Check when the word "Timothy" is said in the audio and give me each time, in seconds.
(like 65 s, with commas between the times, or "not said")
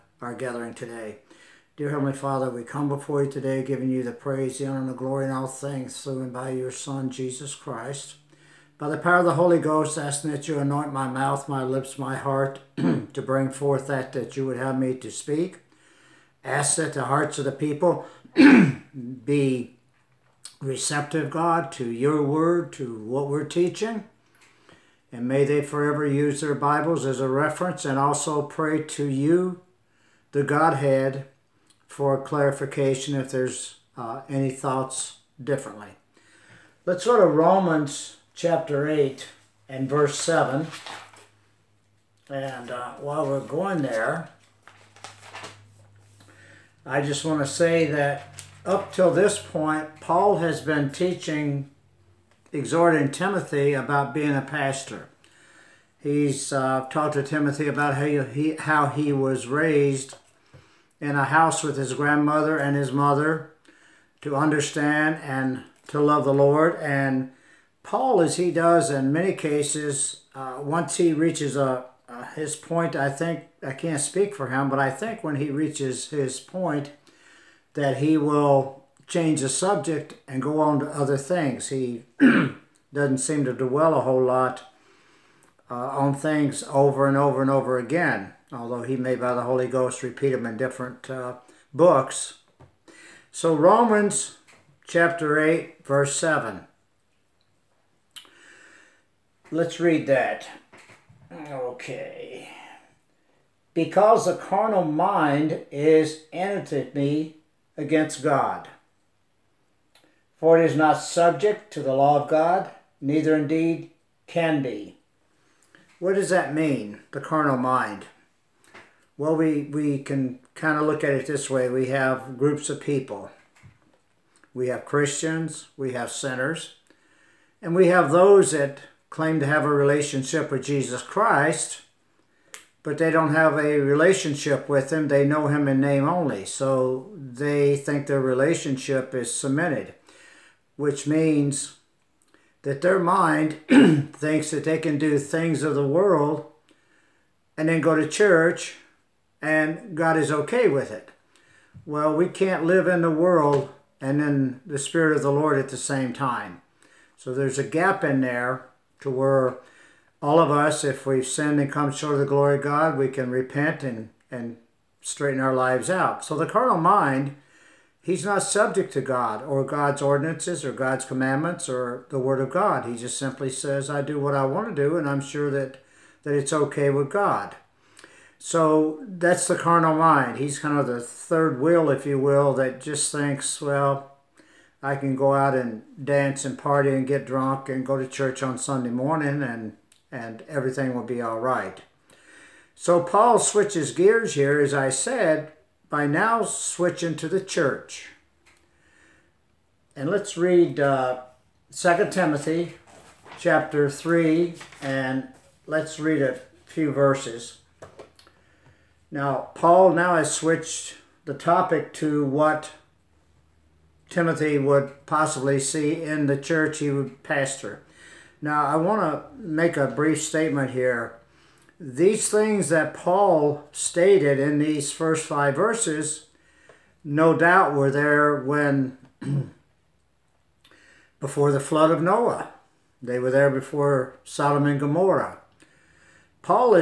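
53 s, 57 s, 202 s, 214 s.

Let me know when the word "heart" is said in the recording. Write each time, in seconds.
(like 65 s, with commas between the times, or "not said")
12 s, 17 s.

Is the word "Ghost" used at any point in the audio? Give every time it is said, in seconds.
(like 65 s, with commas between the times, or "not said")
9 s, 89 s.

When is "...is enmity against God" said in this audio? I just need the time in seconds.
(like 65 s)
105 s.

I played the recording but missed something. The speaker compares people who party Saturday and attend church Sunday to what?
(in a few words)
The third wheel.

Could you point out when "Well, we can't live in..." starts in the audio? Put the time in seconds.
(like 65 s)
151 s.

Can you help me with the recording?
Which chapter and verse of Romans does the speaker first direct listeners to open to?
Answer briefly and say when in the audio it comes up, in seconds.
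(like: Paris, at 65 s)
Romans 8:7, at 37 s.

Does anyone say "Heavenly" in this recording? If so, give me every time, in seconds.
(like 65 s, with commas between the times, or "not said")
1 s.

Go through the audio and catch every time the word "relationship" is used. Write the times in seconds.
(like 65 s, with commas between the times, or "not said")
129 s, 133 s, 138 s.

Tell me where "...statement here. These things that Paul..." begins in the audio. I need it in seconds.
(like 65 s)
220 s.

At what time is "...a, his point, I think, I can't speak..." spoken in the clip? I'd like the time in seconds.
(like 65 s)
71 s.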